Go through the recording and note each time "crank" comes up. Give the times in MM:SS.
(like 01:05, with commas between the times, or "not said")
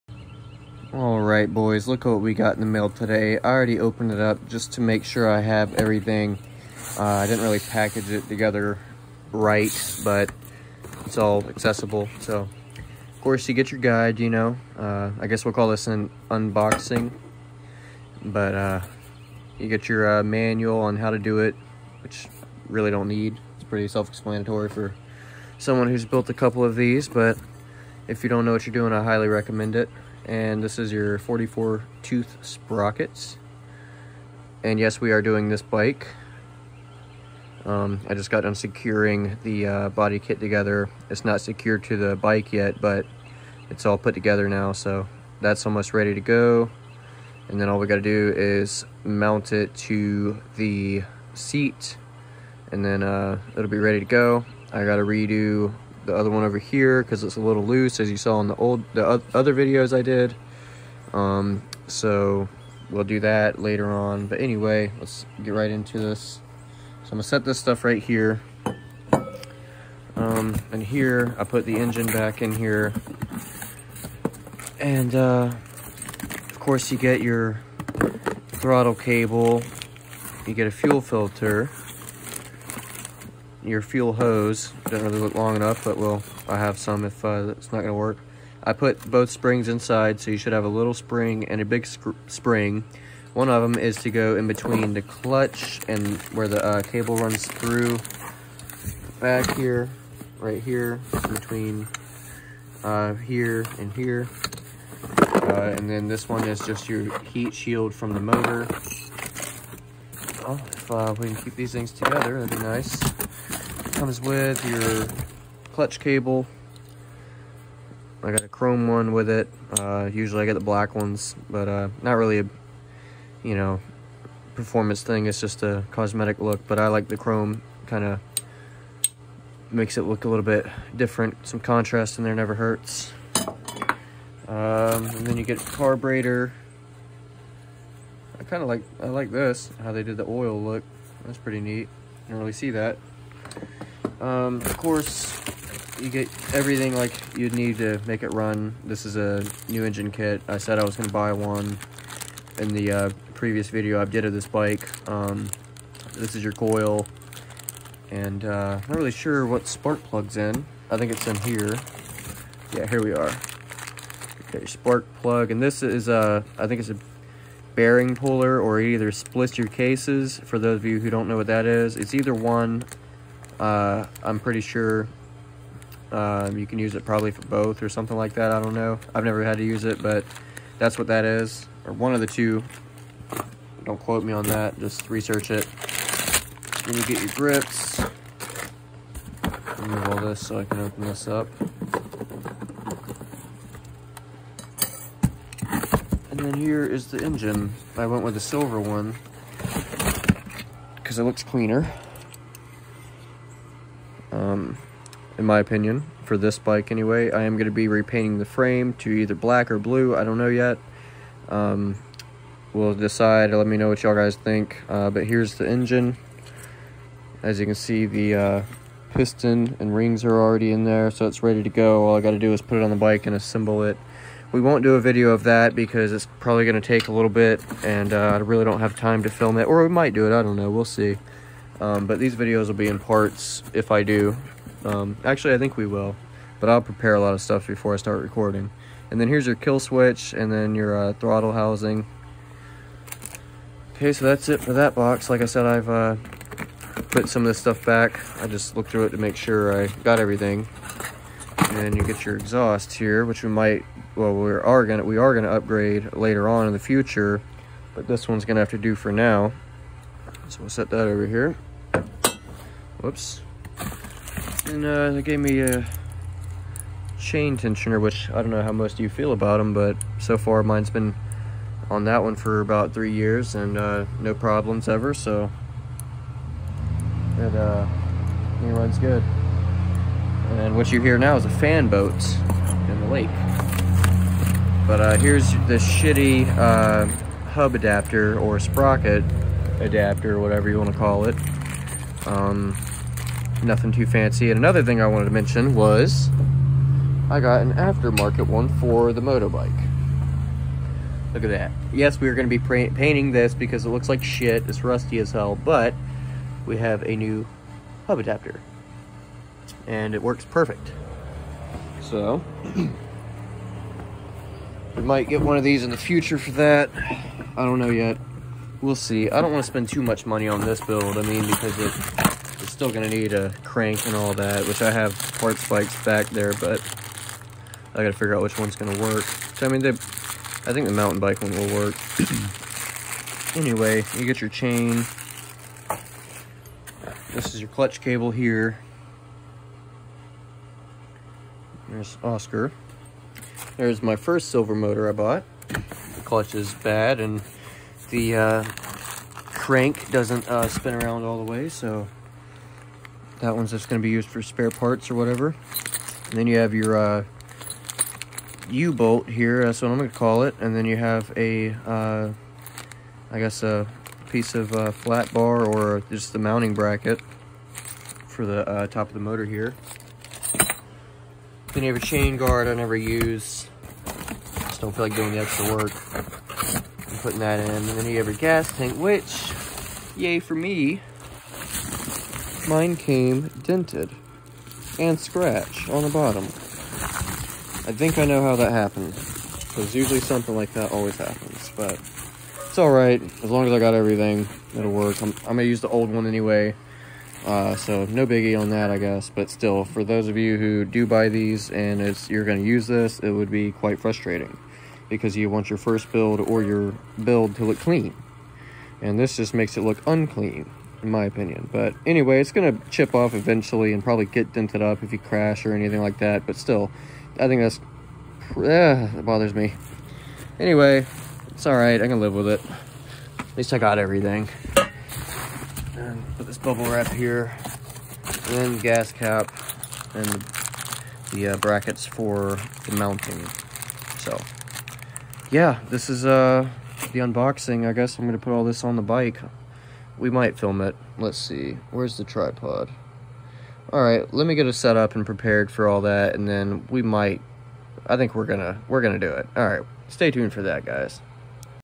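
05:23, 05:49.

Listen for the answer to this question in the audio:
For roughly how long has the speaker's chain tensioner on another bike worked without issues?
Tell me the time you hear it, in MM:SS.
04:32.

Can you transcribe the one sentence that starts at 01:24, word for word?
Doesn't really look long enough, but well, I have some if uh, it's not gonna work.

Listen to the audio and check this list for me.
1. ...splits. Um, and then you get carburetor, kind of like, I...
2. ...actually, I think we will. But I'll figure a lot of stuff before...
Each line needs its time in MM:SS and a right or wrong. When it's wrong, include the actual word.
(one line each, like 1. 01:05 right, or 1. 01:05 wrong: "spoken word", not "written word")
1. 02:12 wrong: "hurts", not "splits"
2. 03:55 wrong: "prepare", not "figure".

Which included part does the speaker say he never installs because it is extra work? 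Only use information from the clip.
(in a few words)
Chain guard.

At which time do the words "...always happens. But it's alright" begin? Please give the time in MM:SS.
06:30.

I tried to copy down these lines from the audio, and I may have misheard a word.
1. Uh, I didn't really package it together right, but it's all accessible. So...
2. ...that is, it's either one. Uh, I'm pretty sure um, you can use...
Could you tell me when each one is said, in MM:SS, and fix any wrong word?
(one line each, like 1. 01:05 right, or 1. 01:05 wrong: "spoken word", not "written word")
1. 00:06 right
2. 02:51 right.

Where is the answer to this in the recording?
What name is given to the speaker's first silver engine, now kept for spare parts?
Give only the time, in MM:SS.
05:42.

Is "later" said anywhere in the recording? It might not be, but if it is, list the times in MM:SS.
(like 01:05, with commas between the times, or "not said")
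01:03, 04:16.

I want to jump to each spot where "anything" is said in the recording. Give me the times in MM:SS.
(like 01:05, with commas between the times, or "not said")
06:55.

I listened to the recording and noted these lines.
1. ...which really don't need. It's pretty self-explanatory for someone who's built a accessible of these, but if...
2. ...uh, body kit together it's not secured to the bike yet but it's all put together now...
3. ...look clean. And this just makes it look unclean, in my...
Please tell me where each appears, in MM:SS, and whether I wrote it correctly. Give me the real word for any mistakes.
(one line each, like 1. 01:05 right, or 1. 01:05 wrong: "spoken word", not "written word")
1. 00:22 wrong: "couple", not "accessible"
2. 00:39 right
3. 06:47 right.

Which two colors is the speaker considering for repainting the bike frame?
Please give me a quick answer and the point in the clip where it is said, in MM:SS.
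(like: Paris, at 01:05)
Black or blue, at 03:29.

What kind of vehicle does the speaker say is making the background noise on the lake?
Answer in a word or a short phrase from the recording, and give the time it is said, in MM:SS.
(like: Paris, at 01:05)
A fan boat, at 04:41.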